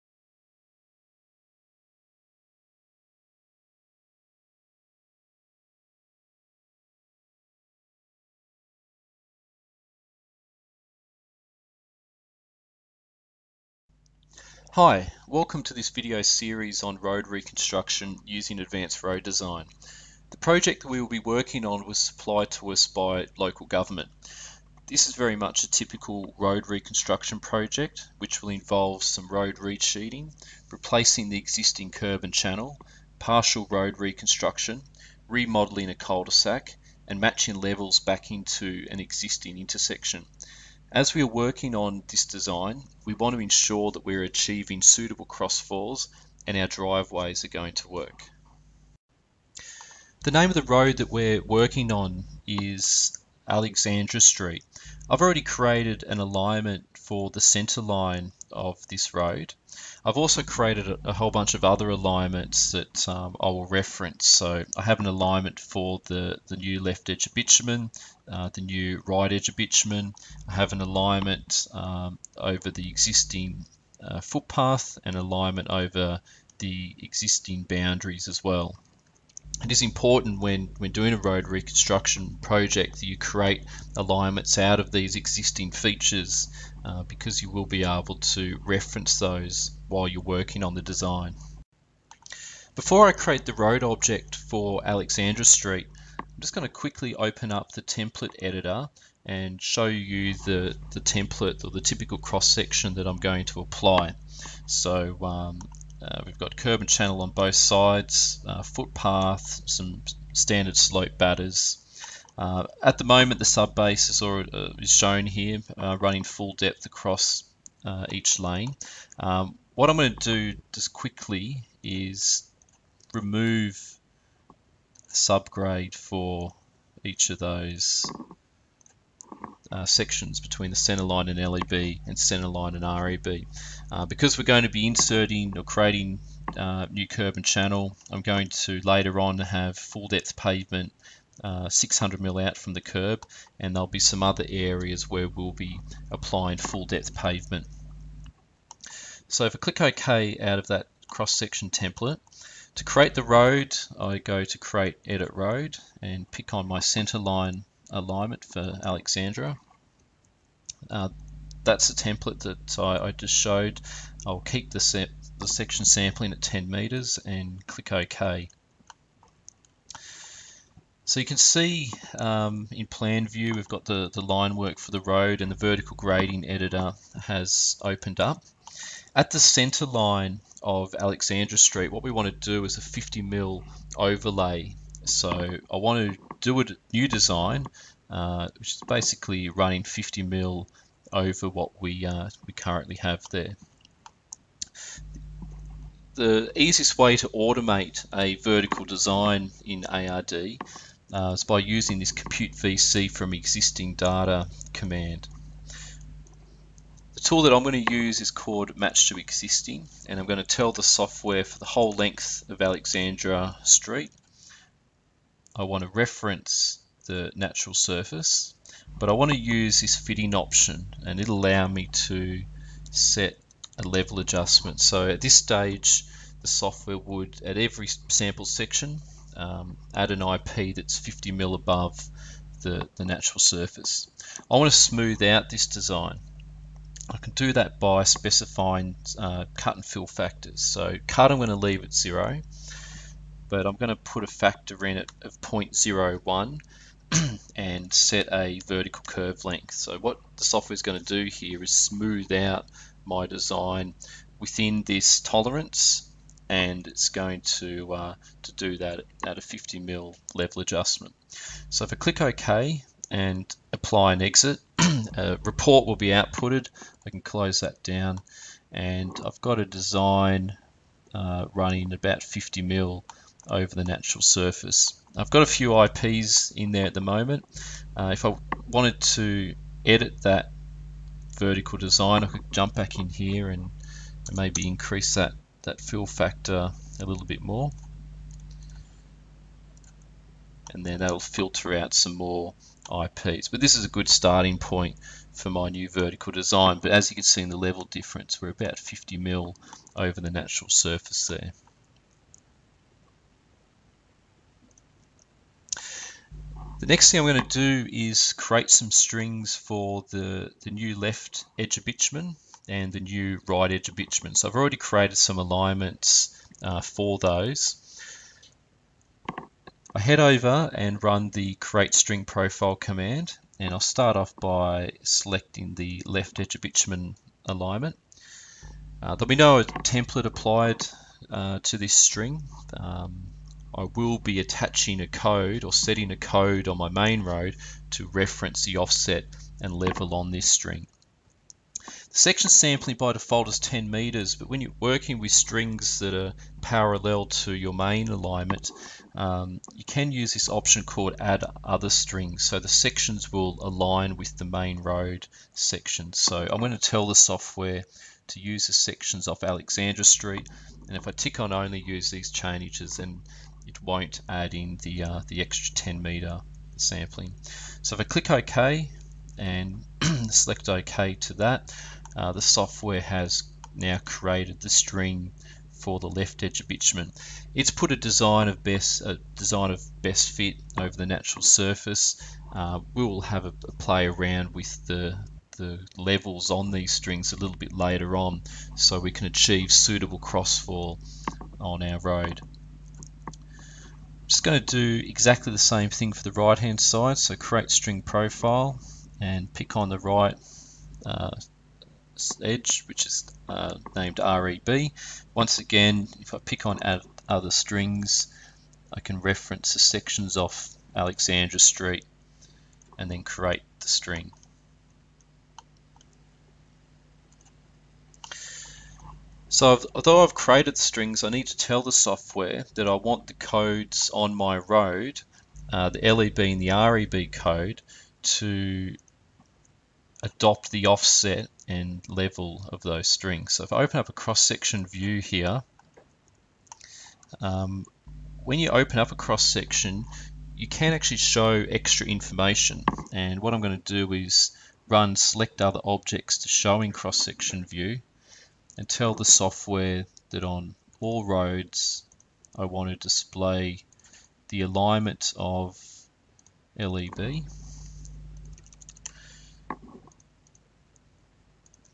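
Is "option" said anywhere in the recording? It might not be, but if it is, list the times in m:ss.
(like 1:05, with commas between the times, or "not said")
3:40, 5:50.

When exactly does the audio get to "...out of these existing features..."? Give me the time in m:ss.
1:24.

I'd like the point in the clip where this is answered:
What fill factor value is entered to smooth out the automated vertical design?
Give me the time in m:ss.
4:05.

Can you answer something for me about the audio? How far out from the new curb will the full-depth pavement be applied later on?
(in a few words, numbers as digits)
600 mm.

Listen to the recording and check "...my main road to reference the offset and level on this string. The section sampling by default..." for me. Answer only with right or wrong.
right.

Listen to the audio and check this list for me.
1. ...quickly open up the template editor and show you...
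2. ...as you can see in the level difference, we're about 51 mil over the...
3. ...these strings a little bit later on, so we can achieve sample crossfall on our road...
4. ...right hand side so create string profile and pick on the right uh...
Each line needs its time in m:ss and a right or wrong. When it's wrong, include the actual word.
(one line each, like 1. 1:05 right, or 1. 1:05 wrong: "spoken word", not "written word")
1. 1:36 right
2. 4:56 wrong: "50", not "51"
3. 6:26 wrong: "suitable", not "sample"
4. 6:36 right.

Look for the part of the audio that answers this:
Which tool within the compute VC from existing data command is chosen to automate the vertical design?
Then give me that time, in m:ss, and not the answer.
3:28.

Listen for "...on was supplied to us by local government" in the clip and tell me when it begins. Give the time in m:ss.
0:21.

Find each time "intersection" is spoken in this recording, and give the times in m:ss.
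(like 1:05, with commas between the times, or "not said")
0:39.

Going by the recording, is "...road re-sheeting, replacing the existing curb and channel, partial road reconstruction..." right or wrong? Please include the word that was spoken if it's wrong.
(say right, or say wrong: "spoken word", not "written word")
right.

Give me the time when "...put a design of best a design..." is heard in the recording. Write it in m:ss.
6:17.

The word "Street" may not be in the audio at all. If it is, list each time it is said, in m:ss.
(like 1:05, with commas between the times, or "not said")
0:54, 1:35, 3:01, 3:33, 6:00, 6:51.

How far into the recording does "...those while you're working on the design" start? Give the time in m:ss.
1:29.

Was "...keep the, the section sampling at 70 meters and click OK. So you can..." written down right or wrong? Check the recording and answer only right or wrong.
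wrong.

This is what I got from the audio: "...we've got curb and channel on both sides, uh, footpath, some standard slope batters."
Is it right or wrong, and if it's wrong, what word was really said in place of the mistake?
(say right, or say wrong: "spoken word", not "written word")
right.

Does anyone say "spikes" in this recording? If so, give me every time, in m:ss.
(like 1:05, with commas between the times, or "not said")
not said.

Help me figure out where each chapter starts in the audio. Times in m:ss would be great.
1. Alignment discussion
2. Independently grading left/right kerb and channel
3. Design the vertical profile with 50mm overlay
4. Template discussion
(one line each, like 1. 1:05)
1. 0:48
2. 5:03
3. 2:50
4. 1:34.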